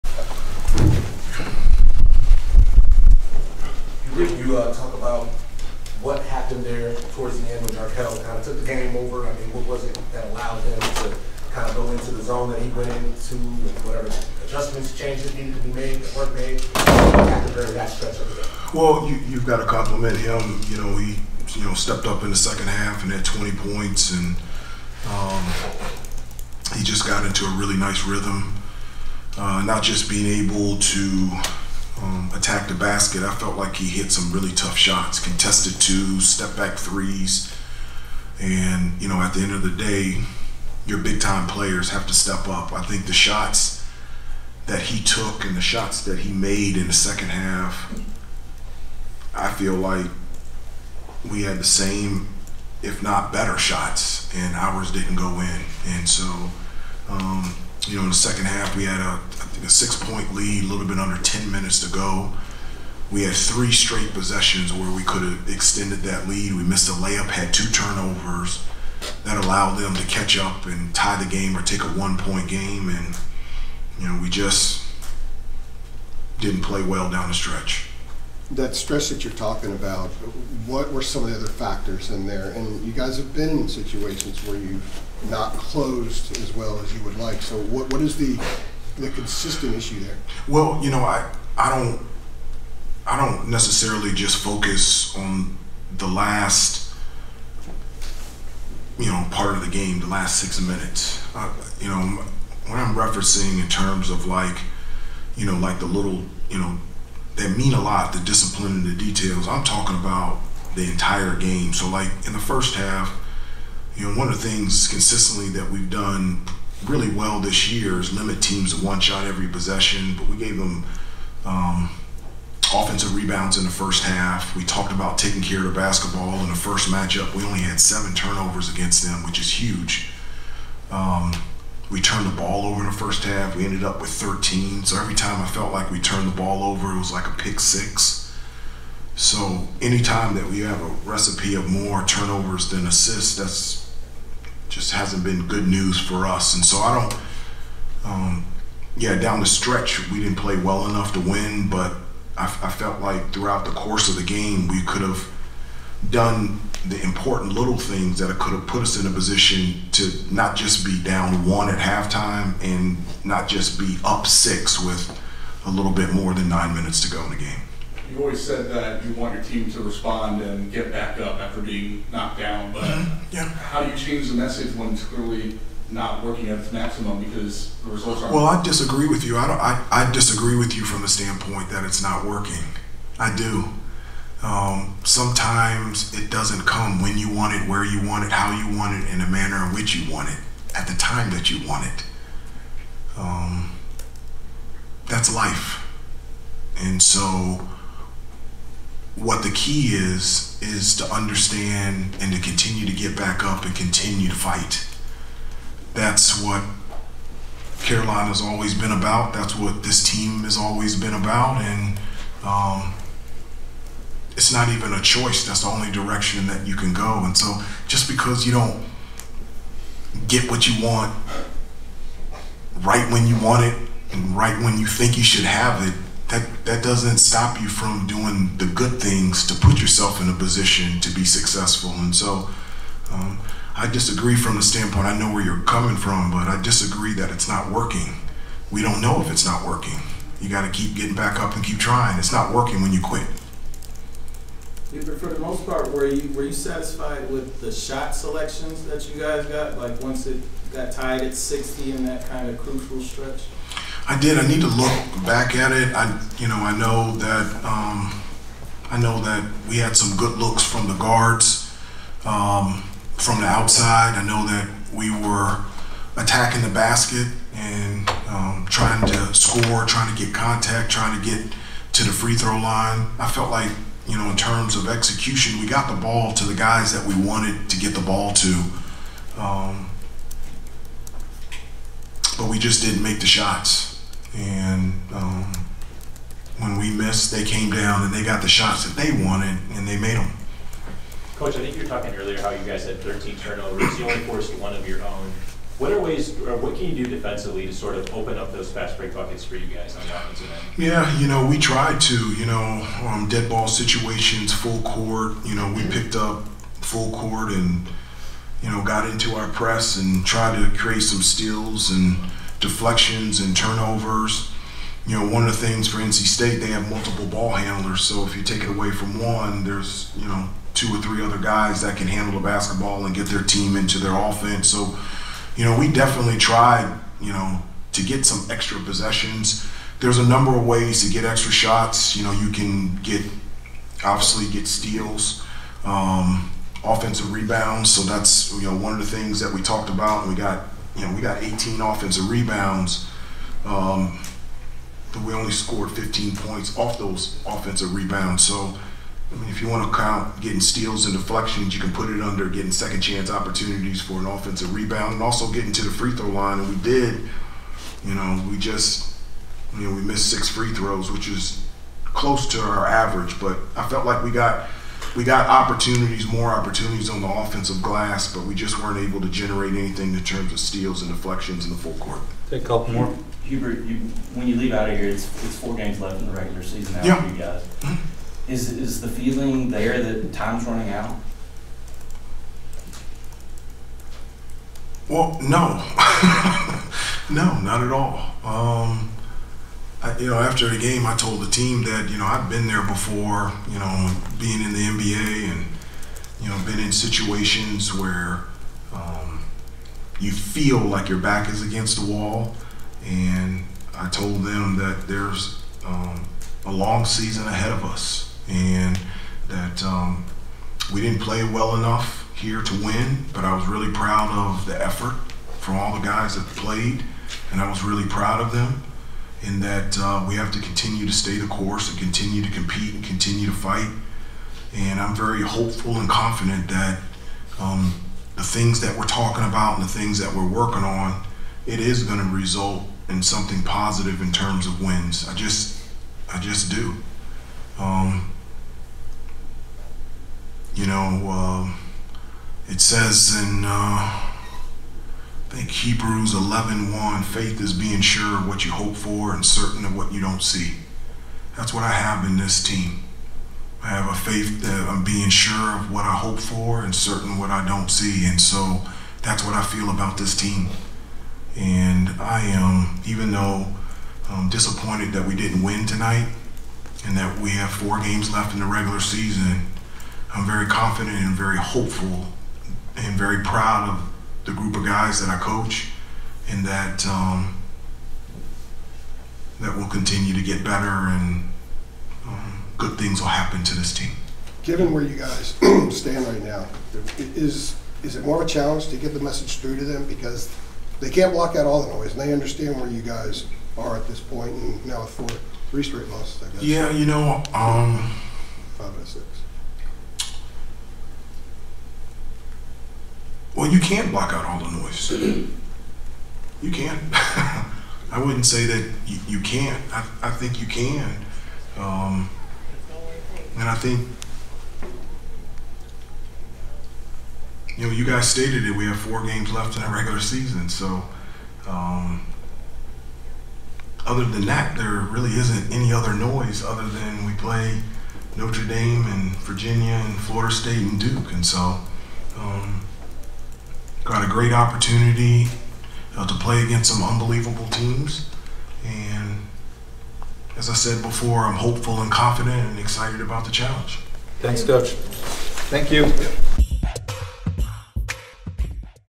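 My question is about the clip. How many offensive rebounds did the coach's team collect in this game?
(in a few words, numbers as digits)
18.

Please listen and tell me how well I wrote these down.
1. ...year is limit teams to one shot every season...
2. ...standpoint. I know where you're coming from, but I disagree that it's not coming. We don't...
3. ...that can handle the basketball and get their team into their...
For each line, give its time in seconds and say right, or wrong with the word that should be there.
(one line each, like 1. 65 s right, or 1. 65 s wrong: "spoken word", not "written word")
1. 117 s wrong: "possession", not "season"
2. 234 s wrong: "working", not "coming"
3. 321 s right.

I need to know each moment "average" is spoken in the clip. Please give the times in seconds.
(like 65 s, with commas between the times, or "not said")
362 s.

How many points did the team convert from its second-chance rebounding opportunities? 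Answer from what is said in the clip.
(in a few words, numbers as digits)
15.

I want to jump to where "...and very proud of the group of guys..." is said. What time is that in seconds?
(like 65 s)
472 s.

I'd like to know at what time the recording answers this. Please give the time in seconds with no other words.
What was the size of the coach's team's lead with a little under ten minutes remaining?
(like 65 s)
59 s.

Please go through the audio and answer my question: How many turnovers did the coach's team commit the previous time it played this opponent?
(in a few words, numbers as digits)
7.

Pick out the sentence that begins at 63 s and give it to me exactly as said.
We had three straight possessions where we could have extended that lead.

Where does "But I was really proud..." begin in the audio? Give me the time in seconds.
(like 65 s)
413 s.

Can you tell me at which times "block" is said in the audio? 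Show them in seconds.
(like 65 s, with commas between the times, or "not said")
491 s, 504 s.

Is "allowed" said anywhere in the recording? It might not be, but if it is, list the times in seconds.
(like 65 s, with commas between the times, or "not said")
10 s, 69 s.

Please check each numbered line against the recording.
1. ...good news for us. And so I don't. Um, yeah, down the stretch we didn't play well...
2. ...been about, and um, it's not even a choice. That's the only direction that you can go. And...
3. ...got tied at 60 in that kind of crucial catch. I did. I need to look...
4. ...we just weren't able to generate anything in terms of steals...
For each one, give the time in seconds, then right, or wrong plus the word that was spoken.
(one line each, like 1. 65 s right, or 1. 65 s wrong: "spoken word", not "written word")
1. 145 s right
2. 210 s right
3. 250 s wrong: "stretch", not "catch"
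4. 368 s right.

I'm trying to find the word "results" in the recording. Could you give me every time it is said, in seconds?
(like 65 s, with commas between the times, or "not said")
177 s, 432 s.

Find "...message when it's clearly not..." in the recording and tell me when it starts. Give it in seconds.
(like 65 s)
174 s.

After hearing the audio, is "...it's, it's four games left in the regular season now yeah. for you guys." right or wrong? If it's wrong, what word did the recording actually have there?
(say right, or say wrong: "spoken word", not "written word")
right.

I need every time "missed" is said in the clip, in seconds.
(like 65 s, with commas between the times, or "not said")
66 s, 286 s, 360 s.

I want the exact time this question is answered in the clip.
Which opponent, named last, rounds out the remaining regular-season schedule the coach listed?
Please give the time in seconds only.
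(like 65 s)
530 s.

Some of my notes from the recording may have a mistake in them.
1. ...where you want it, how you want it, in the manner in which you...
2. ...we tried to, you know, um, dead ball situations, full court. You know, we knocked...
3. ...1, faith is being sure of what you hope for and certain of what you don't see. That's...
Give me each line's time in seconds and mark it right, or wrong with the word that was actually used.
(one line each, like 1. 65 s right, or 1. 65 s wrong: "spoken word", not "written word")
1. 187 s right
2. 301 s wrong: "picked", not "knocked"
3. 446 s right.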